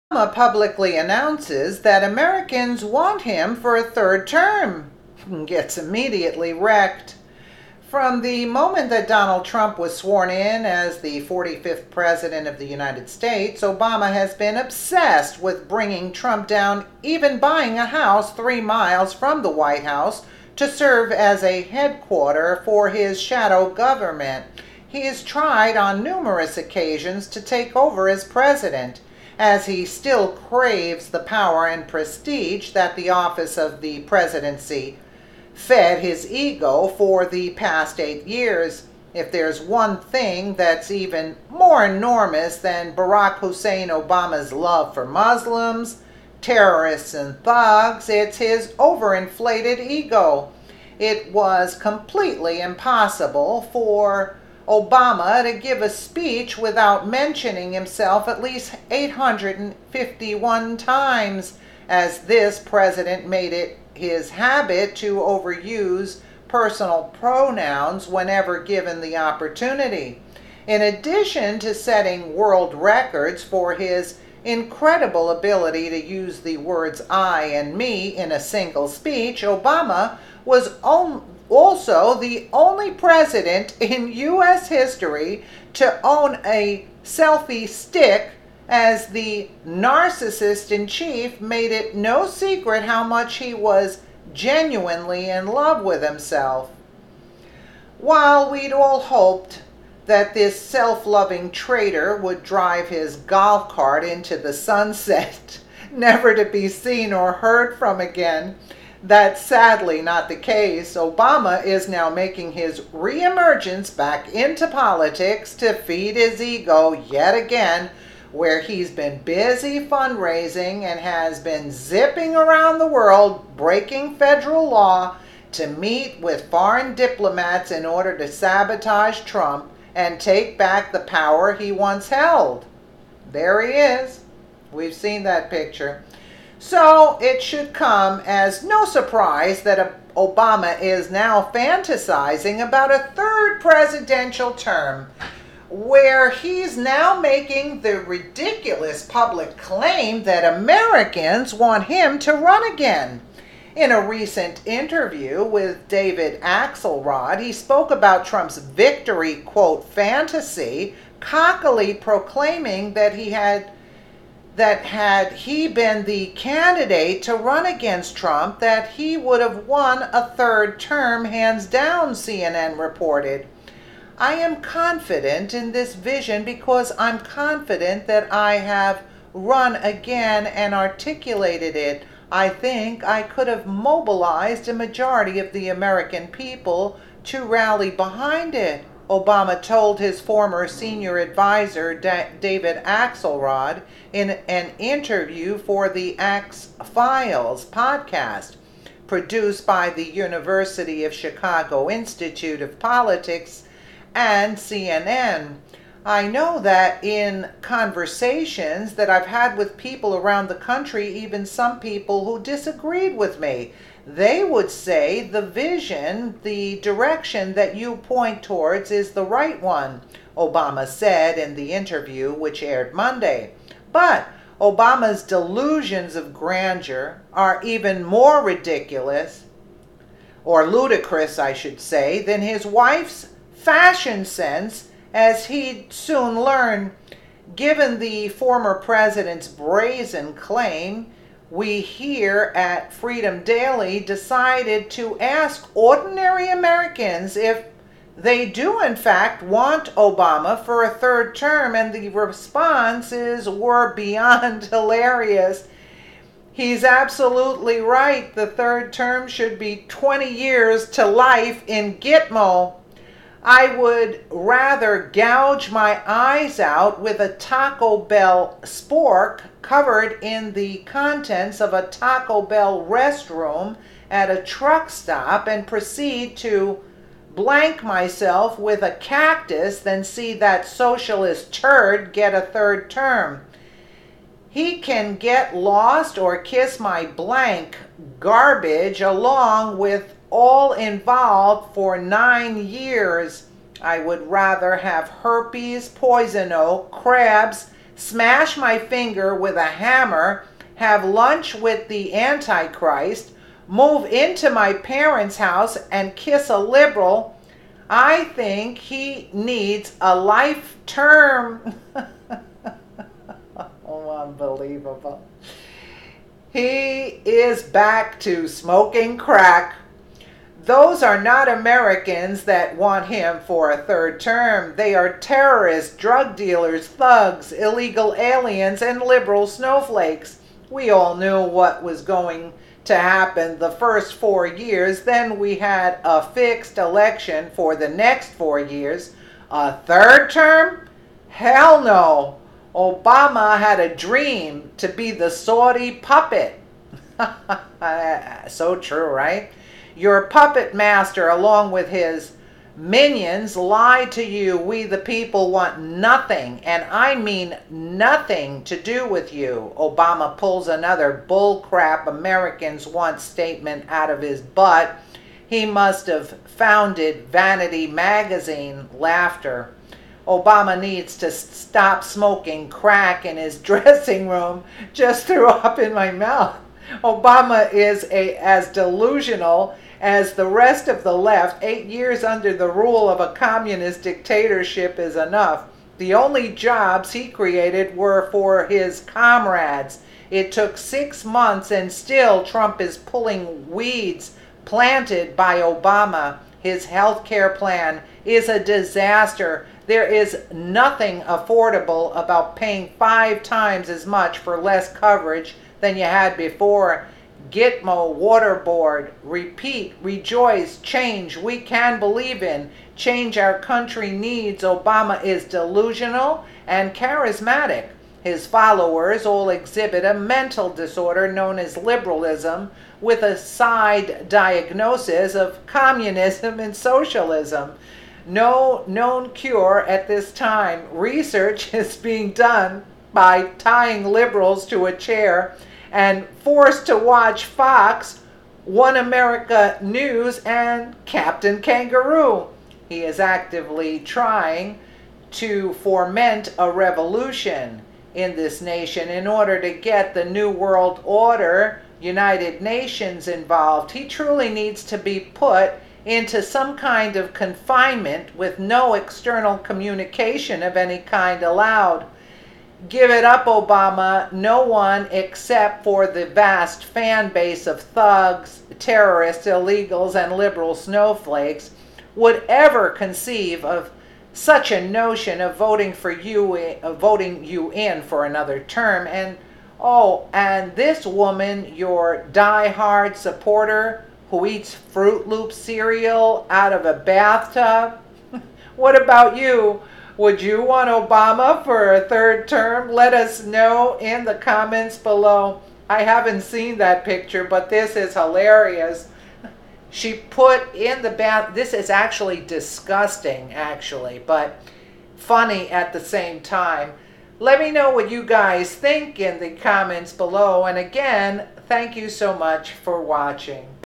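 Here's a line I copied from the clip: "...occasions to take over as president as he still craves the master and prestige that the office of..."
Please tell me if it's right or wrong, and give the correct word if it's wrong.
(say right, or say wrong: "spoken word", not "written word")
wrong: "power", not "master".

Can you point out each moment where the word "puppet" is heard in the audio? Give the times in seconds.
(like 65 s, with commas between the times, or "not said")
345 s, 350 s.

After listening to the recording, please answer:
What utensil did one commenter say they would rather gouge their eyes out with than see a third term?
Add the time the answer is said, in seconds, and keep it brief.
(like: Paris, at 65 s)
Taco Bell spork, at 267 s.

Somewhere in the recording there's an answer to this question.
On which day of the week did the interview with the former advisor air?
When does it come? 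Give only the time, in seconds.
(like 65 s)
222 s.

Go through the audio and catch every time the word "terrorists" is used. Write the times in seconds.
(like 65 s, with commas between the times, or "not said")
46 s, 325 s, 468 s.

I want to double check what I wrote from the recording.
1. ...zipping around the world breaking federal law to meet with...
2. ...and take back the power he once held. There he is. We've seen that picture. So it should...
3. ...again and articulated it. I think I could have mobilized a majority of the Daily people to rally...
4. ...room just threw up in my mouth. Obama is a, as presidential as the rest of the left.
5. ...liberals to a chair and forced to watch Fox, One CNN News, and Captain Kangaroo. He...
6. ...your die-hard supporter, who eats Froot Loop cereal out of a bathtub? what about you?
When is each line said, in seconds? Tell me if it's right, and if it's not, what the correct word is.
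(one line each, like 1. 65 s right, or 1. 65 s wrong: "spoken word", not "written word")
1. 121 s right
2. 129 s right
3. 179 s wrong: "American", not "Daily"
4. 374 s wrong: "delusional", not "presidential"
5. 434 s wrong: "America", not "CNN"
6. 481 s right.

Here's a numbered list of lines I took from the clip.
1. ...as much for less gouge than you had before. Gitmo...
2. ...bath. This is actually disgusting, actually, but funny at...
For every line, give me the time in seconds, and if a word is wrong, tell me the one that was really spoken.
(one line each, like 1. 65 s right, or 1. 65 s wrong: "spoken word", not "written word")
1. 403 s wrong: "coverage", not "gouge"
2. 501 s right.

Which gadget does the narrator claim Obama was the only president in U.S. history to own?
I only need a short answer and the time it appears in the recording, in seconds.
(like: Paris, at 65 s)
selfie stick, at 87 s.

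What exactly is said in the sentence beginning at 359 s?
Obama pulls another bullcrap Americans want statement out of his butt.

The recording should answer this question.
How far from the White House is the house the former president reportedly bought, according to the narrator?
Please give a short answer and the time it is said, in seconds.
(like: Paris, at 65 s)
3 miles, at 18 s.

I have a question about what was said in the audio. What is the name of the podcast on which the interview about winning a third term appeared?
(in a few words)
Axe Files.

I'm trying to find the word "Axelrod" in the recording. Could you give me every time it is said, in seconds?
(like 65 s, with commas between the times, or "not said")
156 s, 192 s.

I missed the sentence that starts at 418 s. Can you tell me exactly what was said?
His followers all exhibit a mental disorder known as liberalism with a side diagnosis of communism and socialism.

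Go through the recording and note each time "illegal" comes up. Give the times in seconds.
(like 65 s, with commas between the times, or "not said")
327 s, 469 s.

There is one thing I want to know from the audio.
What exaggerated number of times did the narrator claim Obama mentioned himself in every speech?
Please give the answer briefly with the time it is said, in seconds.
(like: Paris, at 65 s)
851, at 58 s.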